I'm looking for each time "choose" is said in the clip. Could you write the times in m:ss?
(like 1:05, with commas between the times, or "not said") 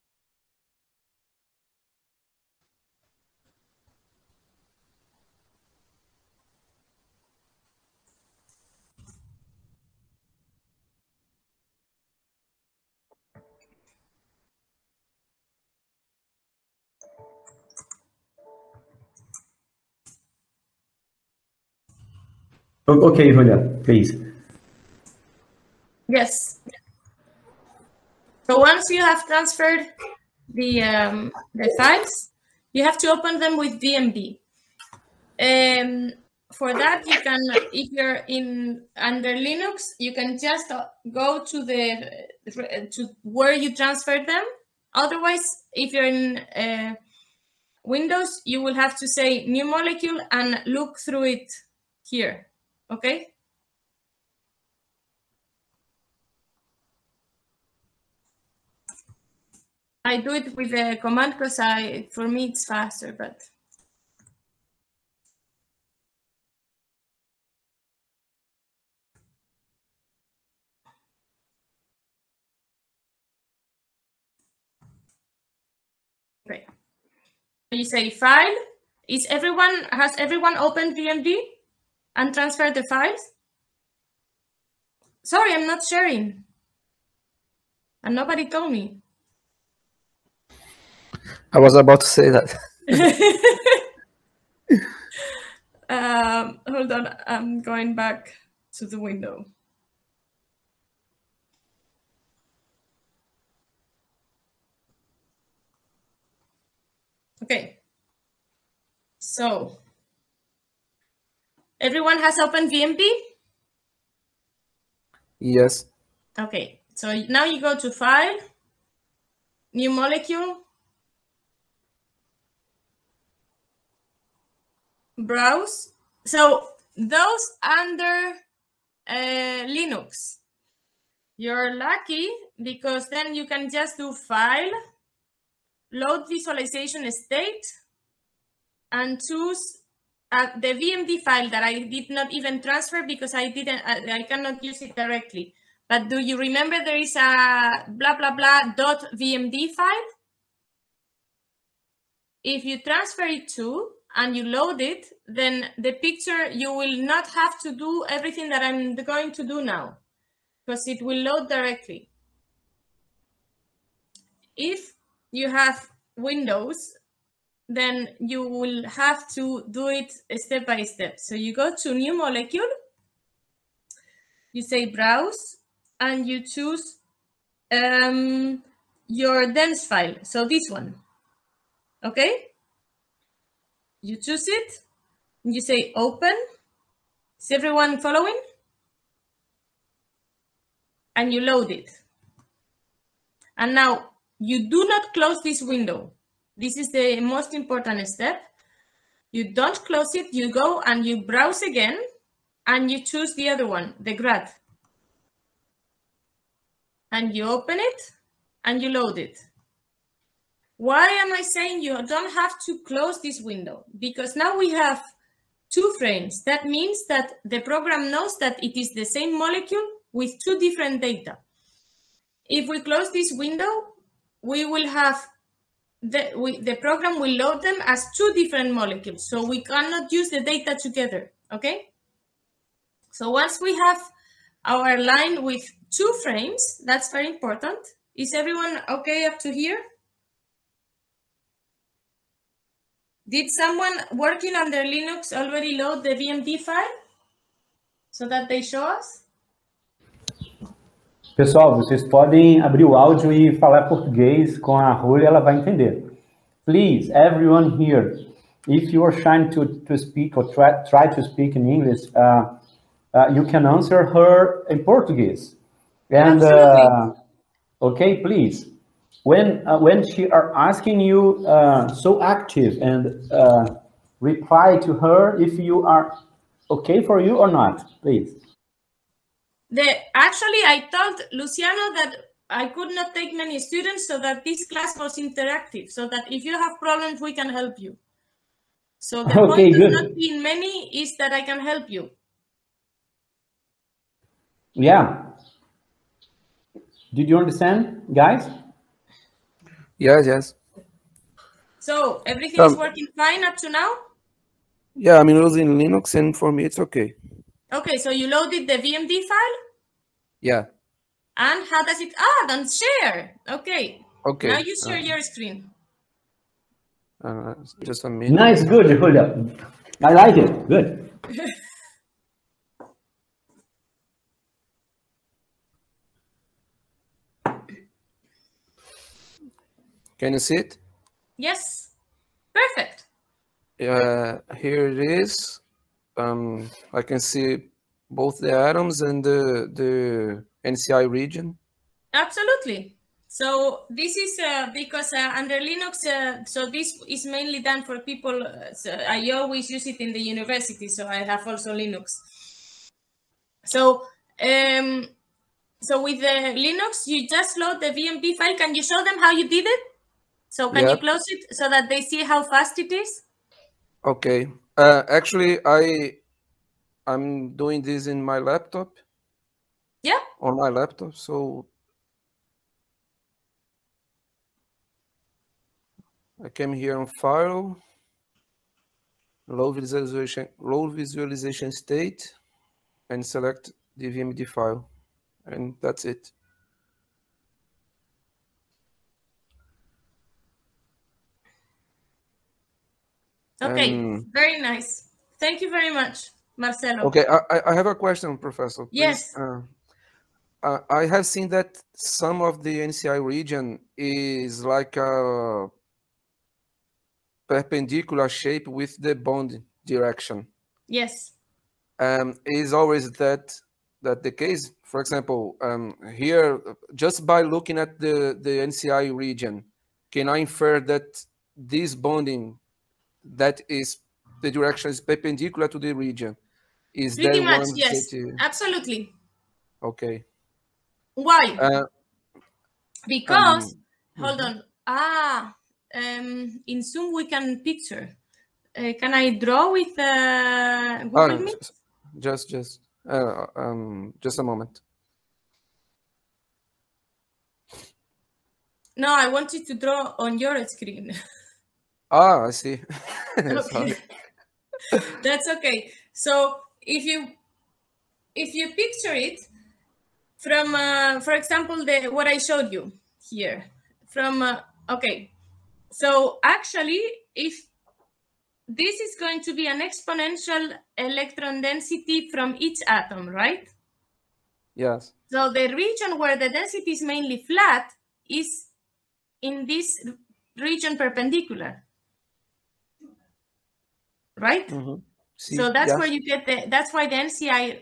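2:19, 2:56, 3:04, 3:23.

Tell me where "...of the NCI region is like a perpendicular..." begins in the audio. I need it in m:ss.
6:42.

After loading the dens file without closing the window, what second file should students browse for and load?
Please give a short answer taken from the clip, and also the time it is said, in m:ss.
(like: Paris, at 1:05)
grad, at 3:23.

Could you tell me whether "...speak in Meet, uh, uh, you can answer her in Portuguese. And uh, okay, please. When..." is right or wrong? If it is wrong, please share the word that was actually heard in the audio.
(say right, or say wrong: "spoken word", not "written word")
wrong: "English", not "Meet".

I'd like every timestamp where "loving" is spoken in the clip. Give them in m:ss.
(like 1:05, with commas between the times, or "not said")
not said.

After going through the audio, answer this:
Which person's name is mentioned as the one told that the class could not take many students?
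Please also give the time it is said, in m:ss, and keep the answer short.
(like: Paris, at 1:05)
Luciano, at 4:41.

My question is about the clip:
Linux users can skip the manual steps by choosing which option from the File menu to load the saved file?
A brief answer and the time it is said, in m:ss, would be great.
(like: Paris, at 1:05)
Load Visualization State, at 2:15.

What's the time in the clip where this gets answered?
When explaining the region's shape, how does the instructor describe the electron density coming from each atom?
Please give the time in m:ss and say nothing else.
7:49.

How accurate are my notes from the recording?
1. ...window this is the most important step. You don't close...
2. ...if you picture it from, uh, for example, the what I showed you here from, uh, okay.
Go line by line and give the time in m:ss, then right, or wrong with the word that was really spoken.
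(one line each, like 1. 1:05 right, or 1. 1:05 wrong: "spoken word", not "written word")
1. 3:15 right
2. 7:38 right.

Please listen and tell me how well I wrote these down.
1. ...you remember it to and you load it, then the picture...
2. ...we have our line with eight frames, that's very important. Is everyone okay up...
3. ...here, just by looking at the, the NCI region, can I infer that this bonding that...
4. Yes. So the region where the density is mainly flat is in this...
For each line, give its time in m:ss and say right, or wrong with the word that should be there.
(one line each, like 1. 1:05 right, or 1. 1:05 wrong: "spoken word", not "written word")
1. 2:32 wrong: "transfer", not "remember"
2. 3:53 wrong: "two", not "eight"
3. 6:56 right
4. 7:54 right.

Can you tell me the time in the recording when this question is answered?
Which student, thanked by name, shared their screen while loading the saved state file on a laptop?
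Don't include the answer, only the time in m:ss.
6:36.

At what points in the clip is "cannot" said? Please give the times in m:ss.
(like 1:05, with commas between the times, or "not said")
2:24, 3:49.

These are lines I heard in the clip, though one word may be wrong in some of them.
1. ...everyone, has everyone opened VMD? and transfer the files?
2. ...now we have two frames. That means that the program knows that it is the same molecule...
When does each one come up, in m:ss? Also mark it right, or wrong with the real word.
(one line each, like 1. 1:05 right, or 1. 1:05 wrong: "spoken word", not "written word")
1. 1:19 right
2. 3:34 right.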